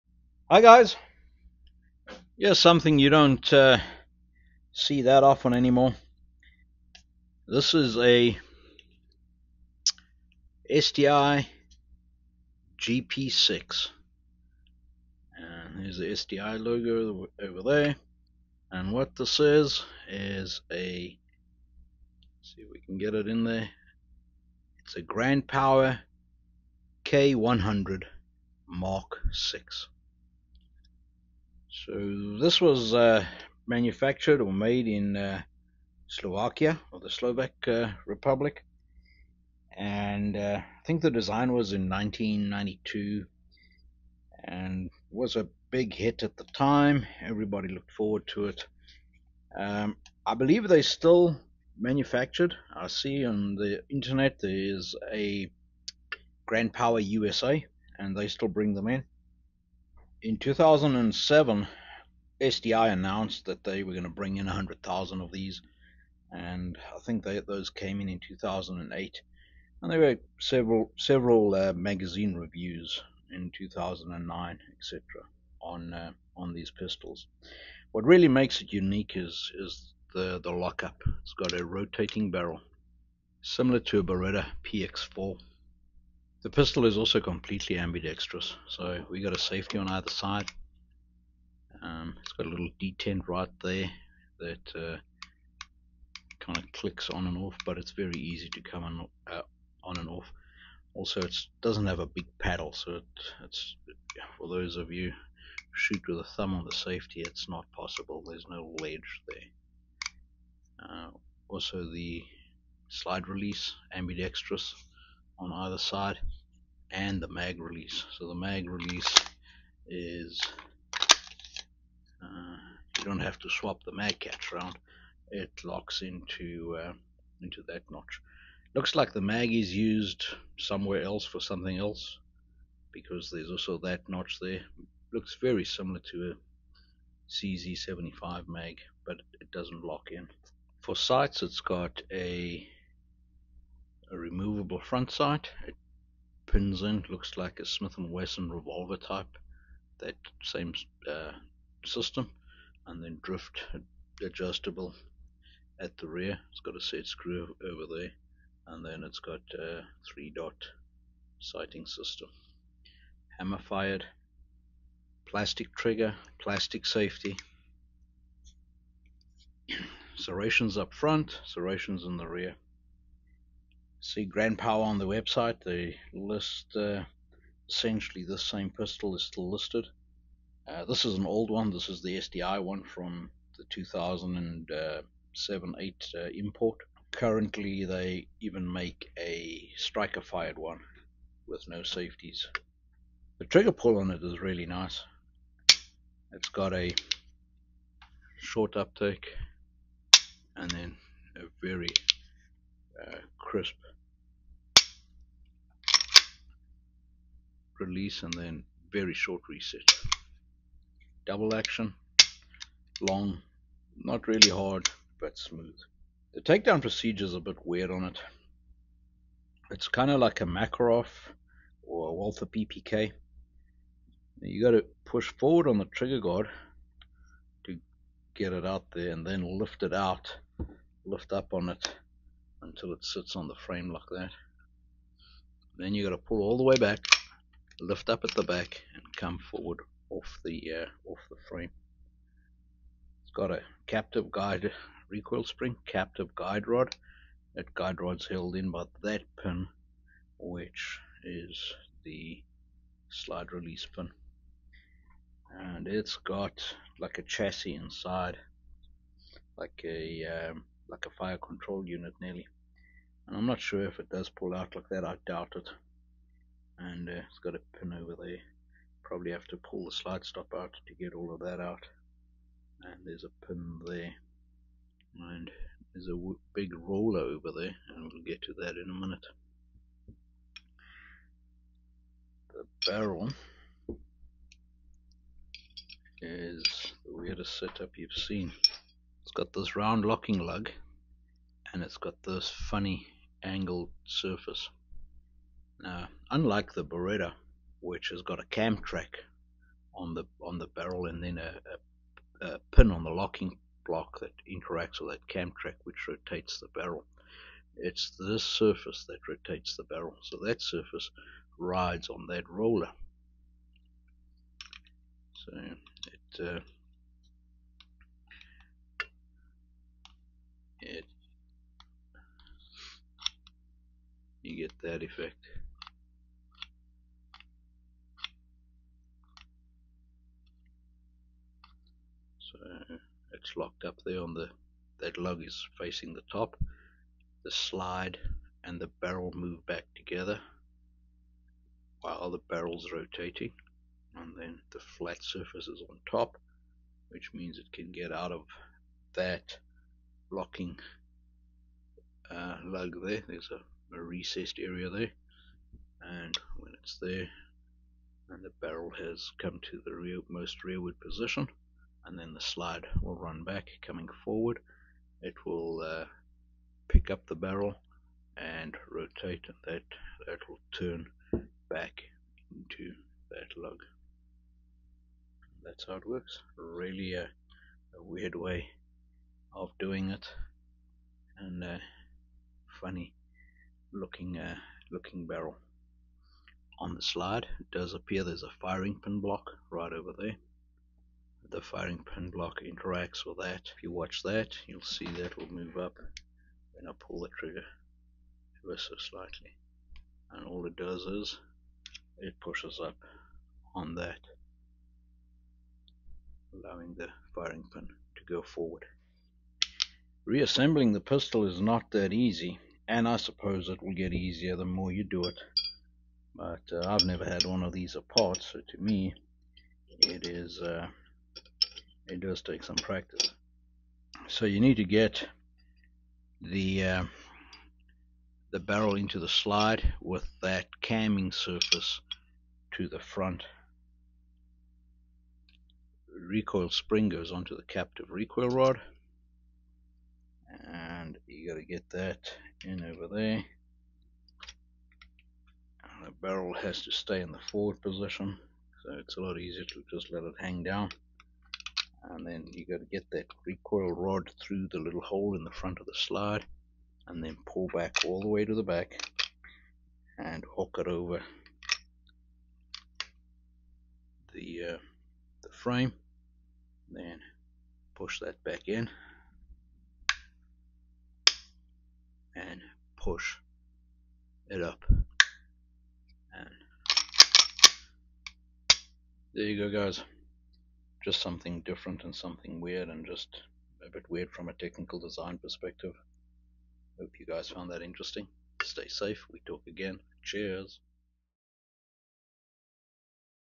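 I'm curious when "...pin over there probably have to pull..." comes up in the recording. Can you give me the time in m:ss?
4:27.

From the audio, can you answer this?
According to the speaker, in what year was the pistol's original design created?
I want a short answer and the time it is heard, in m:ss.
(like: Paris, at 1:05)
1992, at 0:41.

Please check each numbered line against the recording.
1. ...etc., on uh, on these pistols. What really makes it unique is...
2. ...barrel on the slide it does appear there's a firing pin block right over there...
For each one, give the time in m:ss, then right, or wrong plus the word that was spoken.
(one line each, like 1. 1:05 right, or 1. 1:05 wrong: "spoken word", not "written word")
1. 1:14 right
2. 6:25 right.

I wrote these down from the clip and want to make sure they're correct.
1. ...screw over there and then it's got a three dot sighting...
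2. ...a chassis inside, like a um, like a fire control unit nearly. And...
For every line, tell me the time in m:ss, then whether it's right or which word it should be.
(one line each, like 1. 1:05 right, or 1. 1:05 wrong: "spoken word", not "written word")
1. 2:37 right
2. 4:17 right.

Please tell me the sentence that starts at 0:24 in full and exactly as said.
It's a Grand Power K100 Mark 6.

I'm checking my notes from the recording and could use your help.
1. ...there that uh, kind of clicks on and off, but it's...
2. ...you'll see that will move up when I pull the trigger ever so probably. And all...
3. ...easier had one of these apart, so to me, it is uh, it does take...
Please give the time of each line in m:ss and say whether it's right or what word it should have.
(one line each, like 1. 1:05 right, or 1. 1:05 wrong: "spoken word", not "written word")
1. 1:33 right
2. 6:34 wrong: "slightly", not "probably"
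3. 6:57 wrong: "never", not "easier".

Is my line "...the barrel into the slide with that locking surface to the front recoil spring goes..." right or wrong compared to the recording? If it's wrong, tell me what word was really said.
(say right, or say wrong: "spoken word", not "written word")
wrong: "camming", not "locking".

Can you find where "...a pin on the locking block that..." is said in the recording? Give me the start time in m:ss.
5:02.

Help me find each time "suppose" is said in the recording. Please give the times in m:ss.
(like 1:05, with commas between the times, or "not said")
6:53.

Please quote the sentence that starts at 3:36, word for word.
The takedown procedure is a bit weird on it.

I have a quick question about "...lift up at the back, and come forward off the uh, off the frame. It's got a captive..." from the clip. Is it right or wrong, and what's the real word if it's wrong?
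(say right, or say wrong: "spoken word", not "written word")
right.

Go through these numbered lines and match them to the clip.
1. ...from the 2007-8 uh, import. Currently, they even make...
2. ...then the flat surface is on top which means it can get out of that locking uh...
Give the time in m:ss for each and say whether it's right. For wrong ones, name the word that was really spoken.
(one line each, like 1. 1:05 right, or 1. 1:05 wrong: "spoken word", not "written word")
1. 3:02 right
2. 5:44 right.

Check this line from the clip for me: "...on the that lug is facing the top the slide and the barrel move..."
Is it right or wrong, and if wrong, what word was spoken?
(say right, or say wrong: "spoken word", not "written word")
right.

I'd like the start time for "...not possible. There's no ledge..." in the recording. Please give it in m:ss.
1:47.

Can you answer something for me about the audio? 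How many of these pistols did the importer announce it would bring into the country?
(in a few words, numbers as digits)
100,000.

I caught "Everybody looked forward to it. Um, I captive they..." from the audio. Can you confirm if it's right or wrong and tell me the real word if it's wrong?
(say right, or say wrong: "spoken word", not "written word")
wrong: "believe", not "captive".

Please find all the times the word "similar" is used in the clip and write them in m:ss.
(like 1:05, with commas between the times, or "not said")
1:23, 2:15.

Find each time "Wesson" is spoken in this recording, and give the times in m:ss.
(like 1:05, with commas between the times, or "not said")
2:27.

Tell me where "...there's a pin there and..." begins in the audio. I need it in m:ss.
4:33.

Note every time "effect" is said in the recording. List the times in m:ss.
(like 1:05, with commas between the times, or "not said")
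5:25.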